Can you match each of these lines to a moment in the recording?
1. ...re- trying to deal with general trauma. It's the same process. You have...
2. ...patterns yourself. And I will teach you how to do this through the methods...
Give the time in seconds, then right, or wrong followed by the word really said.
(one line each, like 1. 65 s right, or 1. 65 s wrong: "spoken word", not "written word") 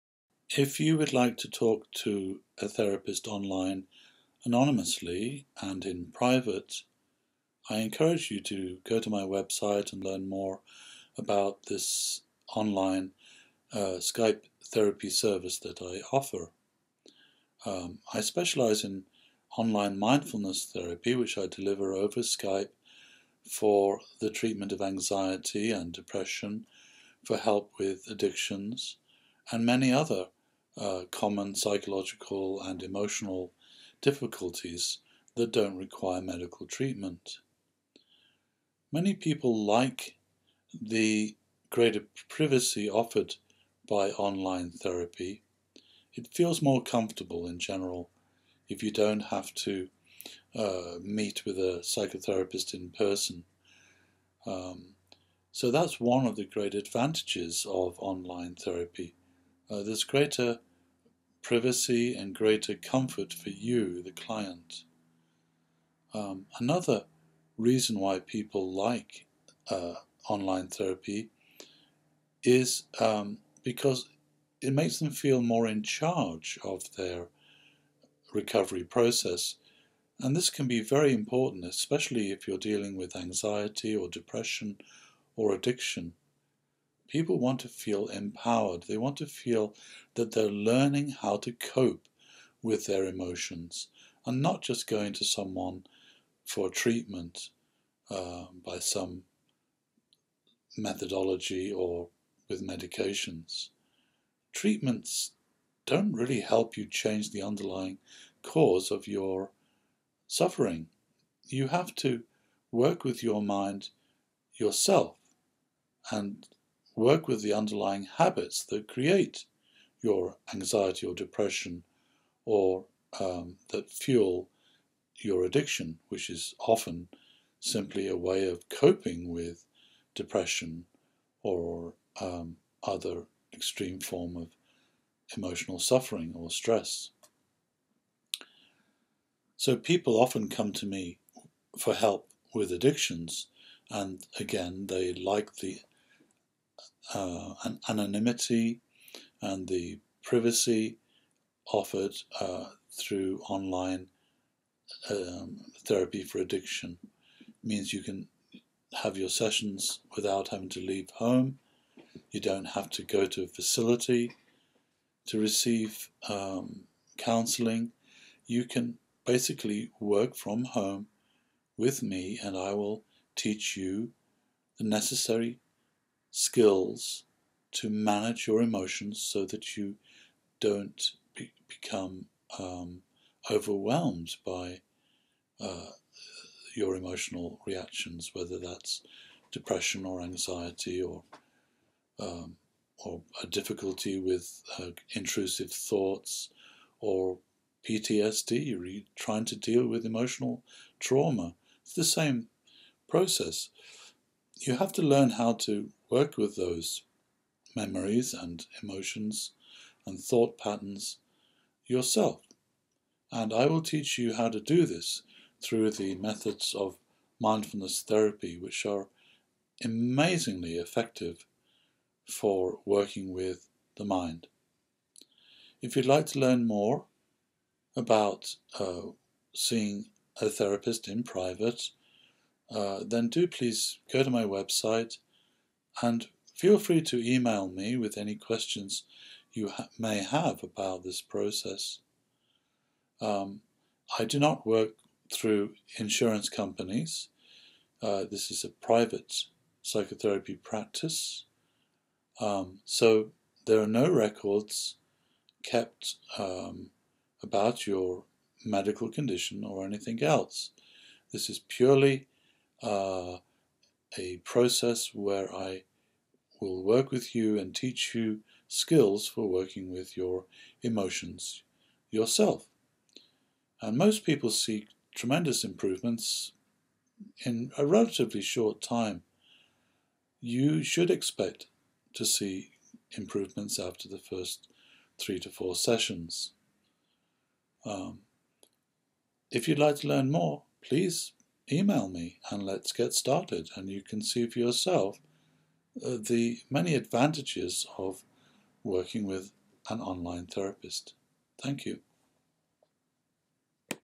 1. 198 s wrong: "emotional", not "general"
2. 210 s right.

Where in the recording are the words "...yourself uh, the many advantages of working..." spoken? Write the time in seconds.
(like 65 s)
294 s.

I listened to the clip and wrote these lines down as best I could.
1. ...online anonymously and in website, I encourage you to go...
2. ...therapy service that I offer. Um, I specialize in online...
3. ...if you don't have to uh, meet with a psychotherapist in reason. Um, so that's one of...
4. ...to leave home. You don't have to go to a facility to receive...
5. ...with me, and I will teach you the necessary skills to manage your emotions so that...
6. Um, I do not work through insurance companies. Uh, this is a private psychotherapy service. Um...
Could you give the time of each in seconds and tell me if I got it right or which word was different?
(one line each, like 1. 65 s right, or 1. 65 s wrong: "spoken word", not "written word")
1. 3 s wrong: "private", not "website"
2. 14 s right
3. 48 s wrong: "person", not "reason"
4. 160 s right
5. 171 s right
6. 243 s wrong: "practice", not "service".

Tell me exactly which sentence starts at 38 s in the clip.
Many people like the greater privacy offered by online therapy.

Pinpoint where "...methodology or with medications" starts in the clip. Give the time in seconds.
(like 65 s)
100 s.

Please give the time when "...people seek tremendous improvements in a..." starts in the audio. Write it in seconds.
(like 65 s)
274 s.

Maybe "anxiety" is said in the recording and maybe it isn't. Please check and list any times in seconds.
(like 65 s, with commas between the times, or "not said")
24 s, 83 s, 120 s, 190 s.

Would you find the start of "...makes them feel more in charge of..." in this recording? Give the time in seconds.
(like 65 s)
74 s.